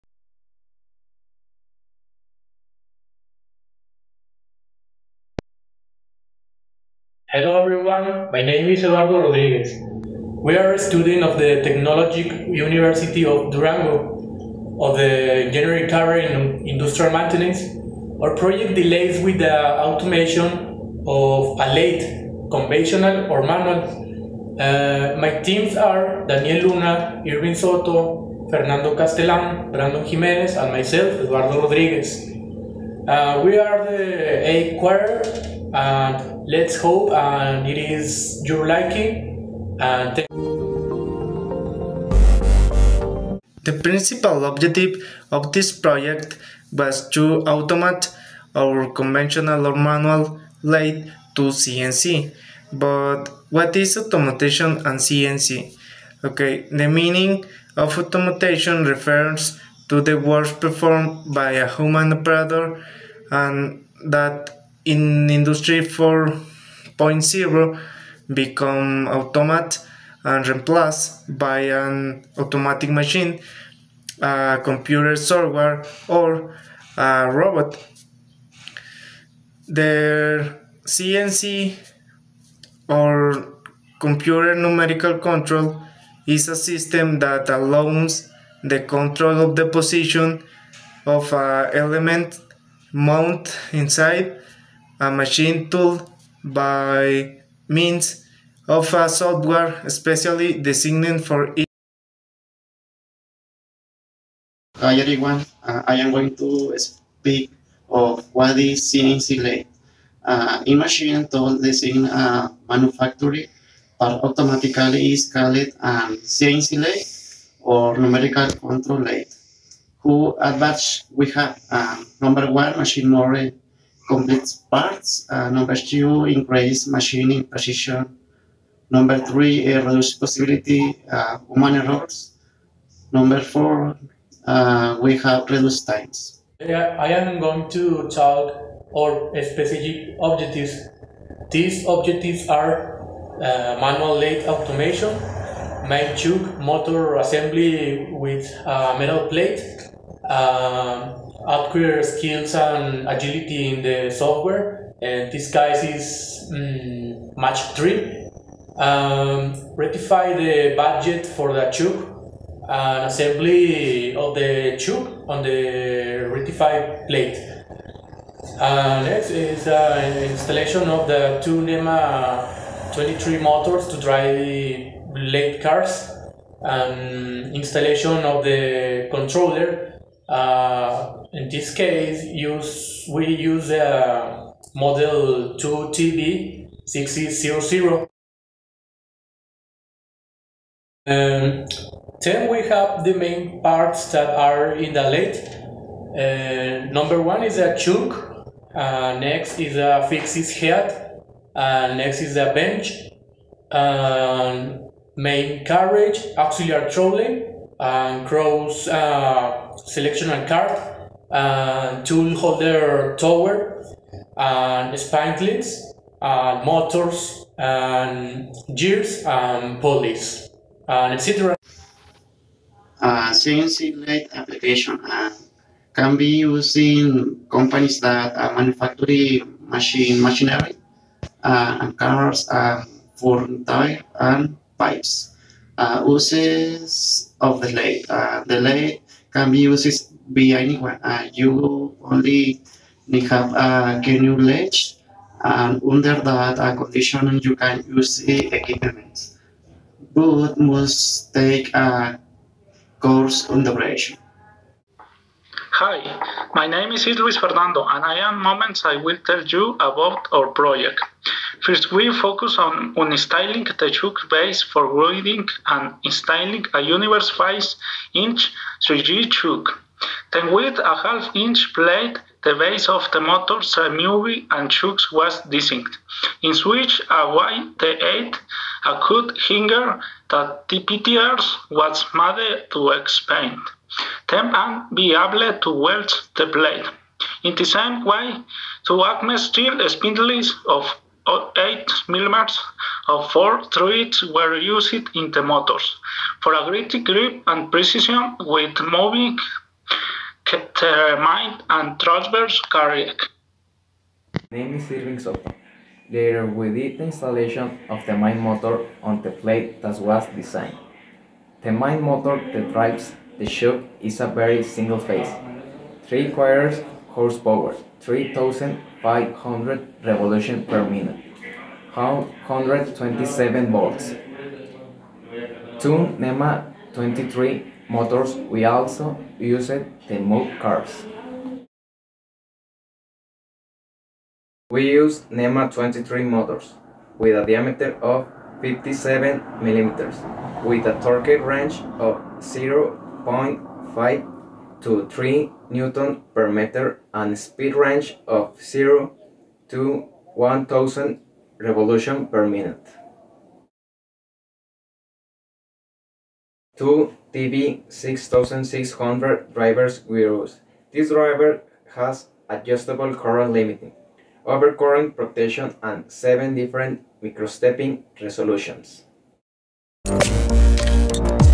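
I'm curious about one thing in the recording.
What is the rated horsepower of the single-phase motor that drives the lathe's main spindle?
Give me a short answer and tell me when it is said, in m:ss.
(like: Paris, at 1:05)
3/4 horsepower, at 5:16.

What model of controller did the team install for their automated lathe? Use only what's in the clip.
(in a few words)
2TB6000.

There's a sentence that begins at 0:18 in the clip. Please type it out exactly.
Our project delays with the automation of a late conventional or manual.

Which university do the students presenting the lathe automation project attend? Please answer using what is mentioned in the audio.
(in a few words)
Technologic University of Durango.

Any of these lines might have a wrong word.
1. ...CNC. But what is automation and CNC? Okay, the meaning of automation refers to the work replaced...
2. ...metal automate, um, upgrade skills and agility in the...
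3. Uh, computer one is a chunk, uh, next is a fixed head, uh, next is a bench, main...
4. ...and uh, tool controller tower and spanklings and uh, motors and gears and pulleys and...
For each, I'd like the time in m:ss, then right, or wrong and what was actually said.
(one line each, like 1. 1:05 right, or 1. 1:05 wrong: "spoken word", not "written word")
1. 0:51 wrong: "performed", not "replaced"
2. 2:28 wrong: "plate", not "automate"
3. 3:16 wrong: "number", not "computer"
4. 3:31 wrong: "holder", not "controller".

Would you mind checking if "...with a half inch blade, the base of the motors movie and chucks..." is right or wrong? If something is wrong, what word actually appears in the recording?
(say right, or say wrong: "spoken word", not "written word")
right.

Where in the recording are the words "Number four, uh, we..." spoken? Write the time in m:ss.
2:13.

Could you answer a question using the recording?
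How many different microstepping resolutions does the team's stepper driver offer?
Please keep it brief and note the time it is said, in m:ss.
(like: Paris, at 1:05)
7, at 6:06.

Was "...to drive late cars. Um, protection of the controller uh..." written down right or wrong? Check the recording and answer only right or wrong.
wrong.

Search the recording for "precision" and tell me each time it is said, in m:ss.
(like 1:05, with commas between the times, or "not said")
2:07, 4:57.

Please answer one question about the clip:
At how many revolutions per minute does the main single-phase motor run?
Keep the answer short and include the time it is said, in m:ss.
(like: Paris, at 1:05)
3500, at 5:18.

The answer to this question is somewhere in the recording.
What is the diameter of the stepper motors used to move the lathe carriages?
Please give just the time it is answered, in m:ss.
5:38.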